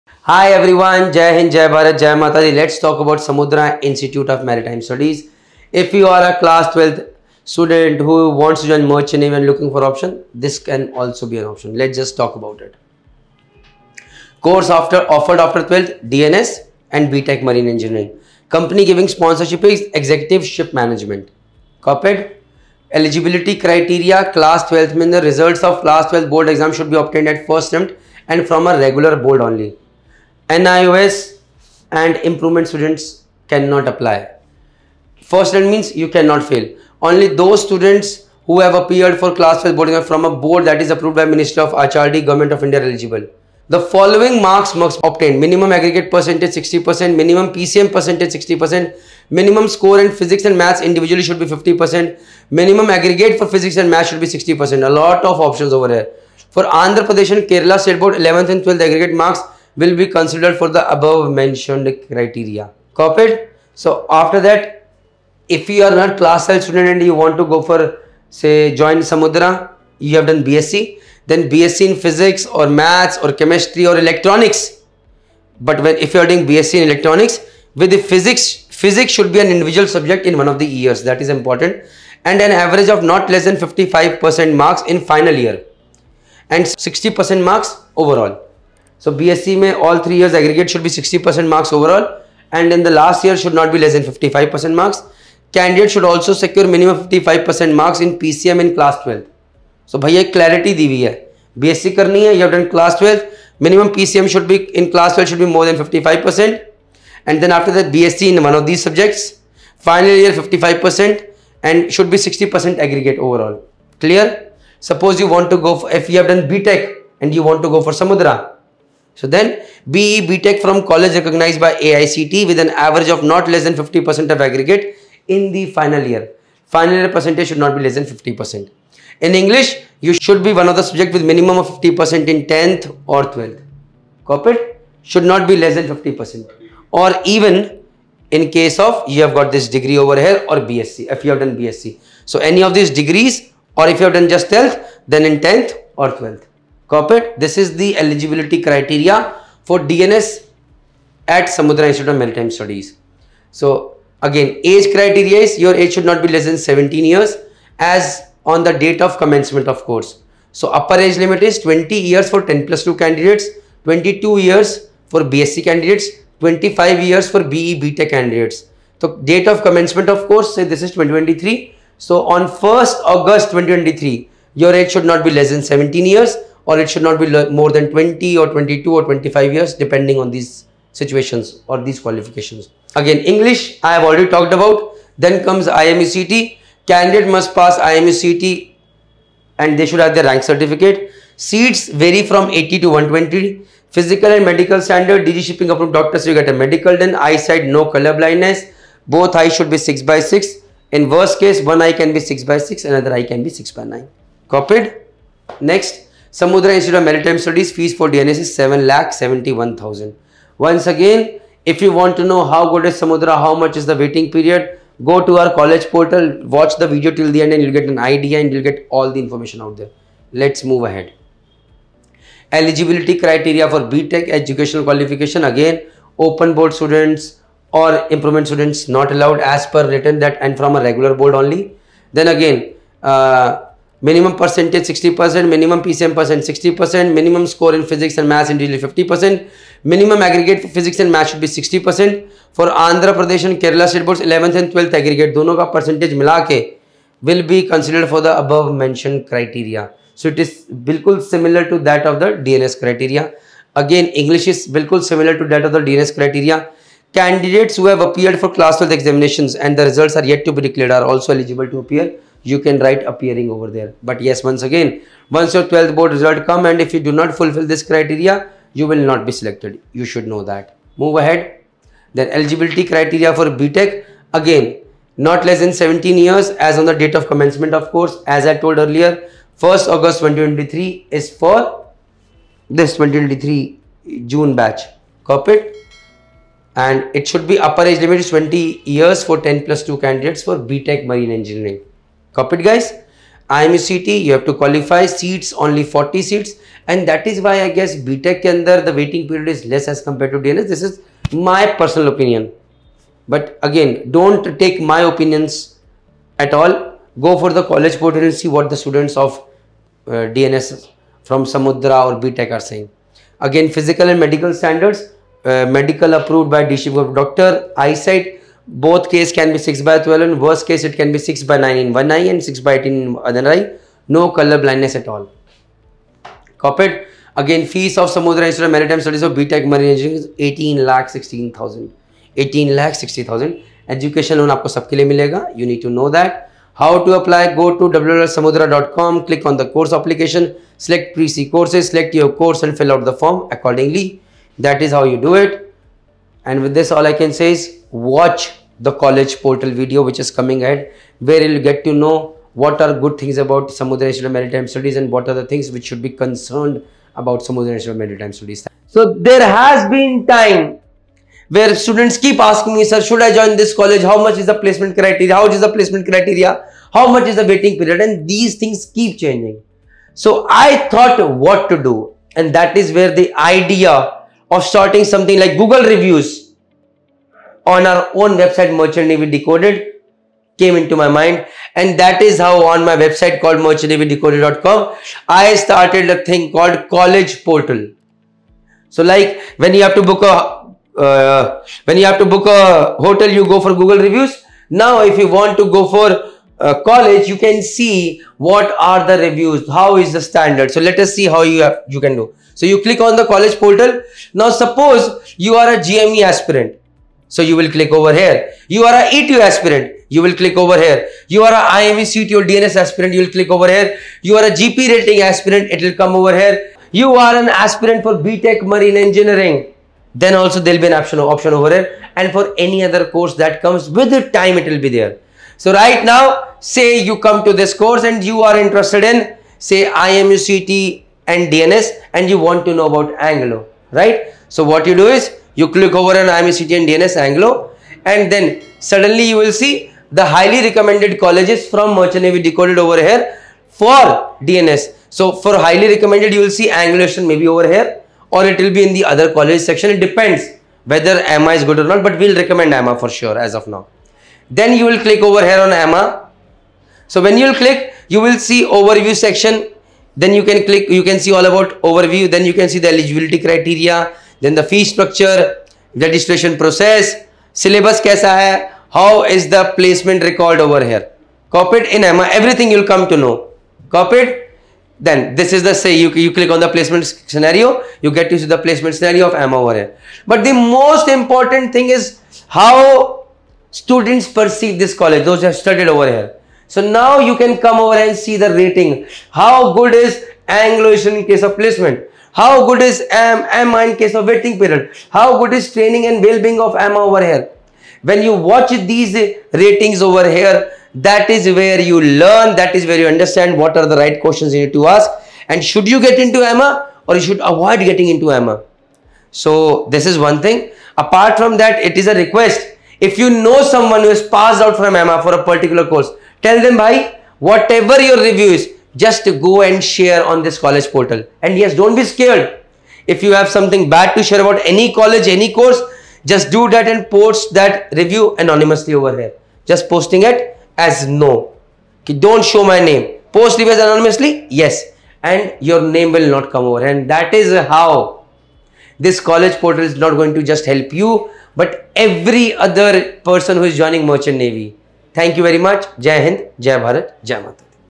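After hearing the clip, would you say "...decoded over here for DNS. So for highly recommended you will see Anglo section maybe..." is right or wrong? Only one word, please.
right.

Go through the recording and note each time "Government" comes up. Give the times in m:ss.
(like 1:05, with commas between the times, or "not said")
0:42.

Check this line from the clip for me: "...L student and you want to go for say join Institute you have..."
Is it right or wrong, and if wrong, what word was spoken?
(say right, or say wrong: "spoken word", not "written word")
wrong: "Samudra", not "Institute".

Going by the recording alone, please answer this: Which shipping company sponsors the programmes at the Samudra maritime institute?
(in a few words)
Executive Ship Management.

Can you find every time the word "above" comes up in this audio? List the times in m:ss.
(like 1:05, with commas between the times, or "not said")
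1:00, 4:08.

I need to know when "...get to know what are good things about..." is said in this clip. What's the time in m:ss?
5:51.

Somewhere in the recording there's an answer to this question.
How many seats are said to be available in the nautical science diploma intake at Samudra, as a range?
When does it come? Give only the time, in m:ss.
3:12.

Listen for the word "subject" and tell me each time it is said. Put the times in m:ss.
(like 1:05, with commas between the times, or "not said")
1:19, 1:48, 2:10.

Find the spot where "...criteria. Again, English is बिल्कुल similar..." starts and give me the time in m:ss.
4:12.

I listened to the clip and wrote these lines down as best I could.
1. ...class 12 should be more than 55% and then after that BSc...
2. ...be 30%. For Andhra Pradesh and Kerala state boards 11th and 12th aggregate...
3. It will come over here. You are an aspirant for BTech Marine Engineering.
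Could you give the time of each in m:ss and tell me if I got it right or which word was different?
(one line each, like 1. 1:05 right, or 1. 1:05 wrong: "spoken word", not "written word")
1. 1:44 right
2. 4:01 wrong: "60", not "30"
3. 6:55 right.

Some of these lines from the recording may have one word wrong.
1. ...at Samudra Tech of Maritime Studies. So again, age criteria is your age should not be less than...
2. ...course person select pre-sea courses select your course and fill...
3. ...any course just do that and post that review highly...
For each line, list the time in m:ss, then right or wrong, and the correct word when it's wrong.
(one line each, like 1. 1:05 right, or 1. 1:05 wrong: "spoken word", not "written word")
1. 2:31 wrong: "Institute", not "Tech"
2. 5:39 wrong: "application", not "person"
3. 8:45 wrong: "anonymously", not "highly".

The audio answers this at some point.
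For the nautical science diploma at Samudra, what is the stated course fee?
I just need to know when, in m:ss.
3:28.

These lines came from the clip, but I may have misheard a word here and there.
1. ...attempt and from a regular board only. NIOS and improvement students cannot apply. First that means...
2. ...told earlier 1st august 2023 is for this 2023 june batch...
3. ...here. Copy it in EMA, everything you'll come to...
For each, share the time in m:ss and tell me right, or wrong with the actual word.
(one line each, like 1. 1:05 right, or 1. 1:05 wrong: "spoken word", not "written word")
1. 0:27 right
2. 4:38 right
3. 7:50 right.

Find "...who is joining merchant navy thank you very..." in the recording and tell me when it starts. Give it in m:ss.
9:03.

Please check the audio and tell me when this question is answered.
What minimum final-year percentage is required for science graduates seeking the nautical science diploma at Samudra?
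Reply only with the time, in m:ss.
1:23.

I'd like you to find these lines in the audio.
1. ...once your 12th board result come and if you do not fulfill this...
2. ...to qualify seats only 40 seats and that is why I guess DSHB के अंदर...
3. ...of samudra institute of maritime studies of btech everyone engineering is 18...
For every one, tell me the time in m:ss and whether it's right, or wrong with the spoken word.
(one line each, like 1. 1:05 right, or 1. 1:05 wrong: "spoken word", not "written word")
1. 4:25 right
2. 4:54 wrong: "BTech", not "DSHB"
3. 5:27 wrong: "marine", not "everyone".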